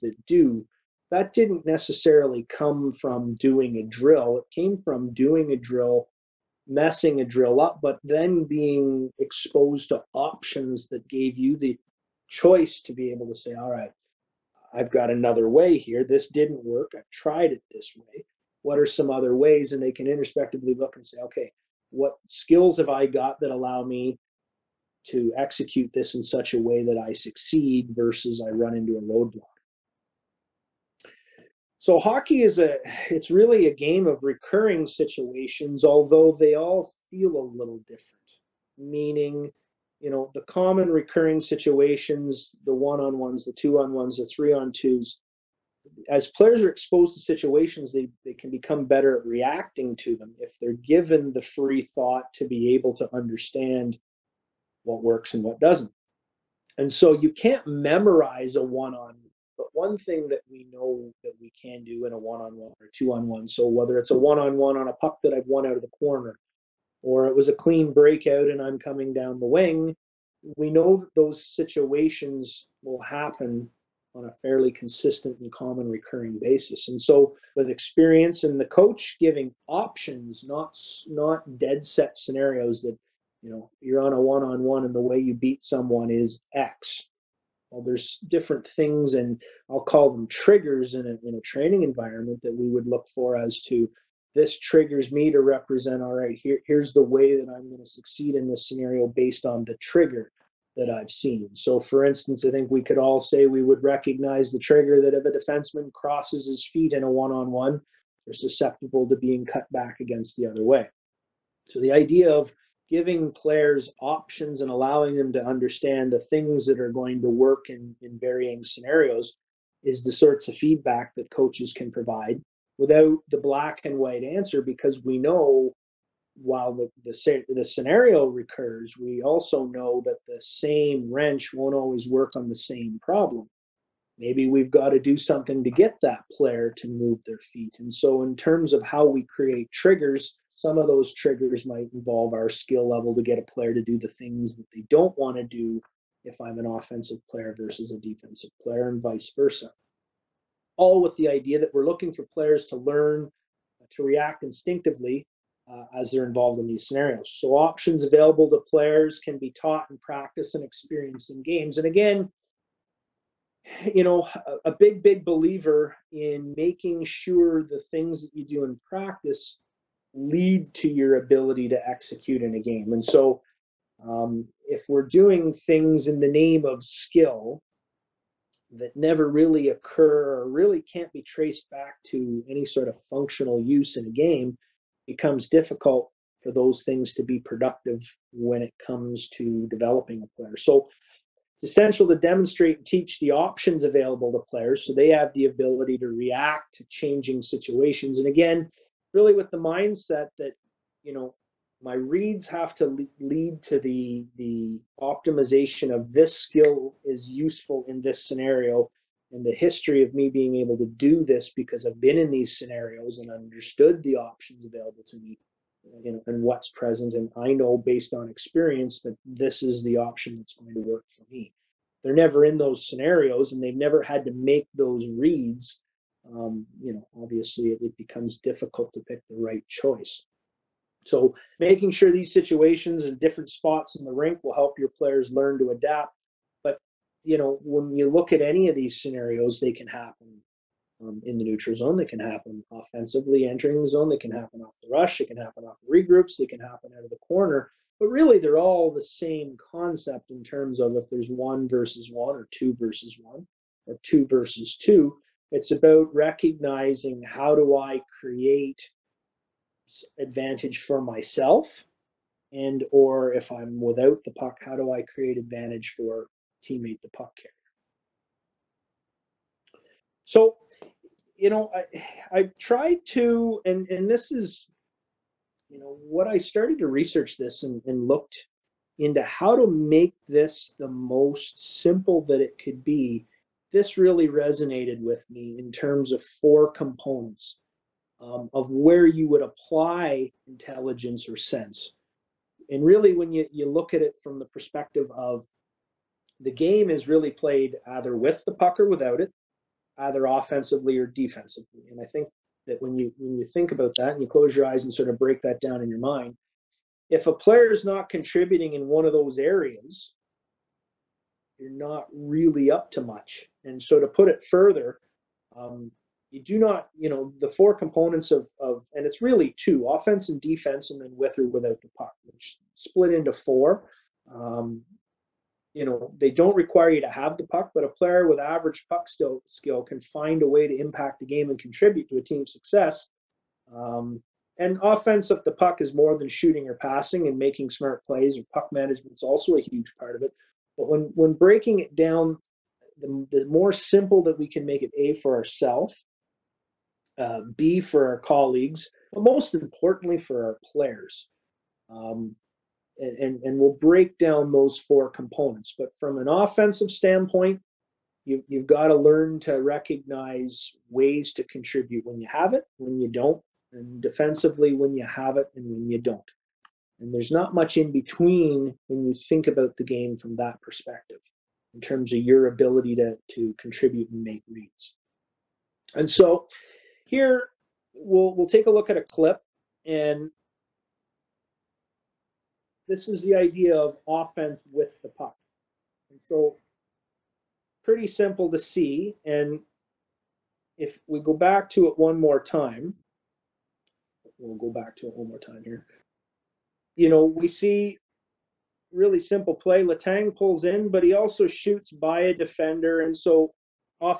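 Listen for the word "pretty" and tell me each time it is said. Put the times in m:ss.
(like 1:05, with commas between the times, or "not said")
6:27.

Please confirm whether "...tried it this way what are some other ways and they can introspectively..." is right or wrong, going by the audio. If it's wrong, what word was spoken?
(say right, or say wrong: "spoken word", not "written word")
right.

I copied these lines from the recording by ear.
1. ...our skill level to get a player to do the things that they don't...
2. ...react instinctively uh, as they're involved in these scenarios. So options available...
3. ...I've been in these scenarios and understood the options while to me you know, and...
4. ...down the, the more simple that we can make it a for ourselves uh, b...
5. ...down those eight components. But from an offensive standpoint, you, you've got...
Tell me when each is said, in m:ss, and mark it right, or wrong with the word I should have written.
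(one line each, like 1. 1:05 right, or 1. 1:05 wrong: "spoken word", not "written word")
1. 2:22 right
2. 2:34 right
3. 3:31 wrong: "available", not "while"
4. 5:41 right
5. 5:54 wrong: "four", not "eight".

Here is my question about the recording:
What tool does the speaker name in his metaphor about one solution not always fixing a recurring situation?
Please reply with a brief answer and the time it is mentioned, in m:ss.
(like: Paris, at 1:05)
wrench, at 2:11.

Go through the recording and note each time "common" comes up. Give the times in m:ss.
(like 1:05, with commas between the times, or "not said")
0:40, 1:15.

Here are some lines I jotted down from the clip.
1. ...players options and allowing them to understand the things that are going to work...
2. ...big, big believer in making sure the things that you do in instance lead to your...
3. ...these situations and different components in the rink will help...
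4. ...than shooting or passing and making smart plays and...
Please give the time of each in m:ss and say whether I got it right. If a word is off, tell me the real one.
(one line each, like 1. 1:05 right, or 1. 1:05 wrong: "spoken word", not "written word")
1. 1:53 right
2. 2:44 wrong: "practice", not "instance"
3. 3:52 wrong: "spots", not "components"
4. 5:36 right.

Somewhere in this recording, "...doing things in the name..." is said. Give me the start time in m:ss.
2:55.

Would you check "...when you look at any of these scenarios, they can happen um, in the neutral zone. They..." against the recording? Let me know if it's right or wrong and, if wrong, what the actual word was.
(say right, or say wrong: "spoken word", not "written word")
right.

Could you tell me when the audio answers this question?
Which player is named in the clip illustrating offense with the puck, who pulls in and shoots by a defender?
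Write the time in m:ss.
6:39.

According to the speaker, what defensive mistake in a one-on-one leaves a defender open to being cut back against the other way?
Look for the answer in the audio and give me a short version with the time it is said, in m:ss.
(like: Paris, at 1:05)
crosses his feet, at 1:45.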